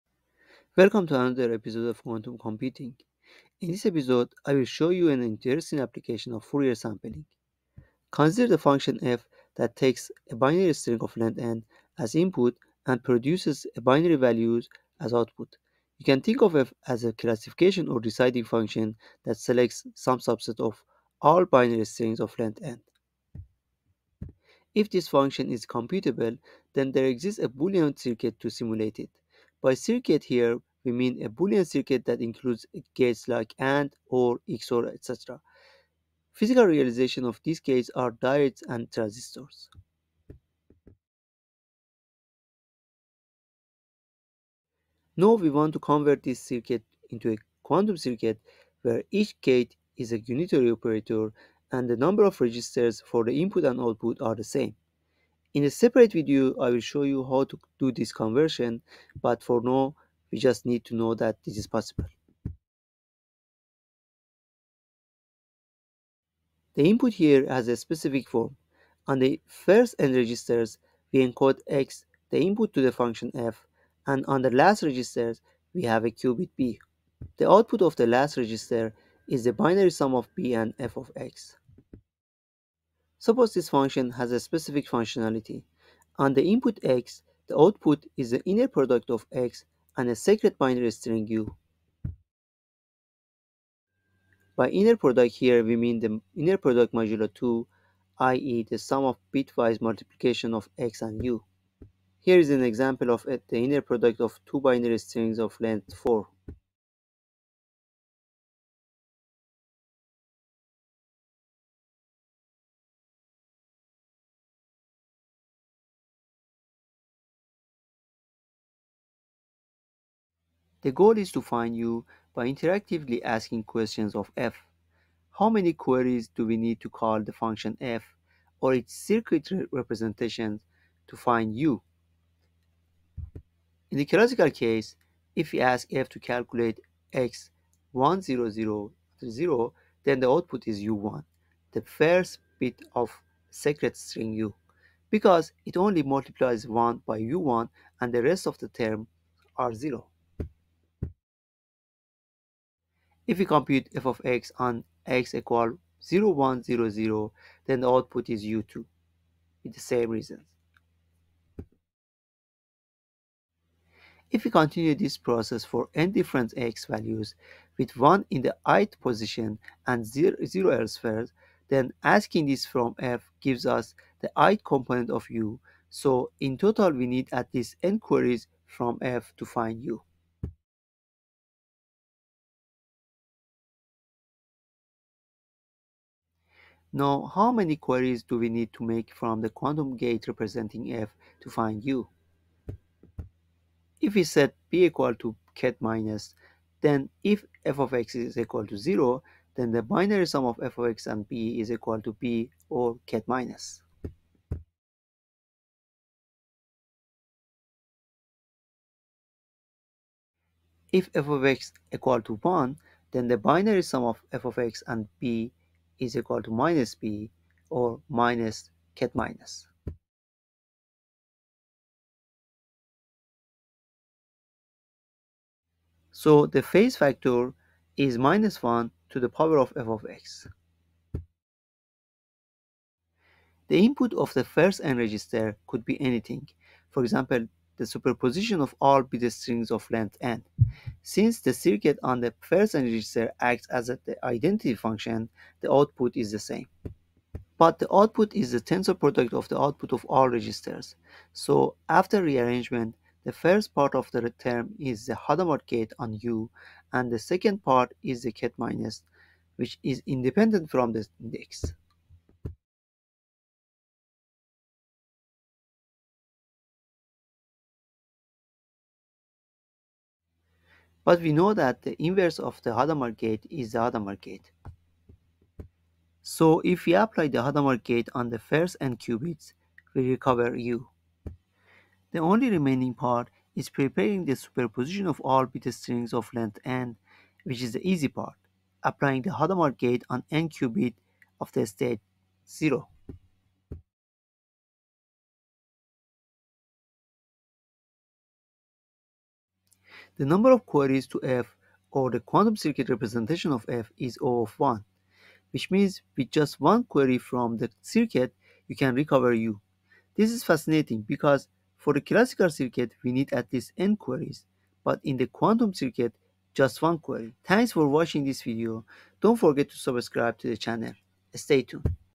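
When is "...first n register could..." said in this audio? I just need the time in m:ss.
3:54.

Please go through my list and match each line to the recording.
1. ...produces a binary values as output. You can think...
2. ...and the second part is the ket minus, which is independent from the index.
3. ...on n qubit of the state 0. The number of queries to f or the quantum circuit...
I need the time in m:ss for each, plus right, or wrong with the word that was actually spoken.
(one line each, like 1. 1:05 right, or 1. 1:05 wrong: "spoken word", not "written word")
1. 0:13 right
2. 4:16 right
3. 4:50 right.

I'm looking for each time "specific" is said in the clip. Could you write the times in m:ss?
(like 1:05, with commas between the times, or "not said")
1:07, 1:24.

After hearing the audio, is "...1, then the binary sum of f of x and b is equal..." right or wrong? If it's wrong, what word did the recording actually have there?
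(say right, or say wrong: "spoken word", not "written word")
right.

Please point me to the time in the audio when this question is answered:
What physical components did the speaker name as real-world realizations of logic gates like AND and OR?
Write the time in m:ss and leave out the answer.
0:38.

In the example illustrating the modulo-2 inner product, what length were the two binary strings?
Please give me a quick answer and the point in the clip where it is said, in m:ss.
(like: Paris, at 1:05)
4, at 1:45.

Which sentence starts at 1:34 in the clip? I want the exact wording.
By inner product here, we mean the inner product modulo 2, i.e.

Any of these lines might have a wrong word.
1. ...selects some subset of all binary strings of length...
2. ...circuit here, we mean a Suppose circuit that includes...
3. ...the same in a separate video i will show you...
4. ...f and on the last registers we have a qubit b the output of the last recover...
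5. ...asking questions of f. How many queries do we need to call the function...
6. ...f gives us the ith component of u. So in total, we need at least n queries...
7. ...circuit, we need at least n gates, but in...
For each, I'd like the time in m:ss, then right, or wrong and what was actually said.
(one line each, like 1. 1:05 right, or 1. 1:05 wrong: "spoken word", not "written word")
1. 0:19 right
2. 0:29 wrong: "Boolean", not "Suppose"
3. 0:54 right
4. 1:13 wrong: "register", not "recover"
5. 2:03 right
6. 2:52 right
7. 5:12 wrong: "queries", not "gates".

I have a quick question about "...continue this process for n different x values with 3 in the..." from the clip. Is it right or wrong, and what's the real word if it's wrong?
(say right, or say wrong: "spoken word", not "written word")
wrong: "1", not "3".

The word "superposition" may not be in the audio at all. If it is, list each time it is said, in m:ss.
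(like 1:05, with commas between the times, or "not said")
3:57, 4:44.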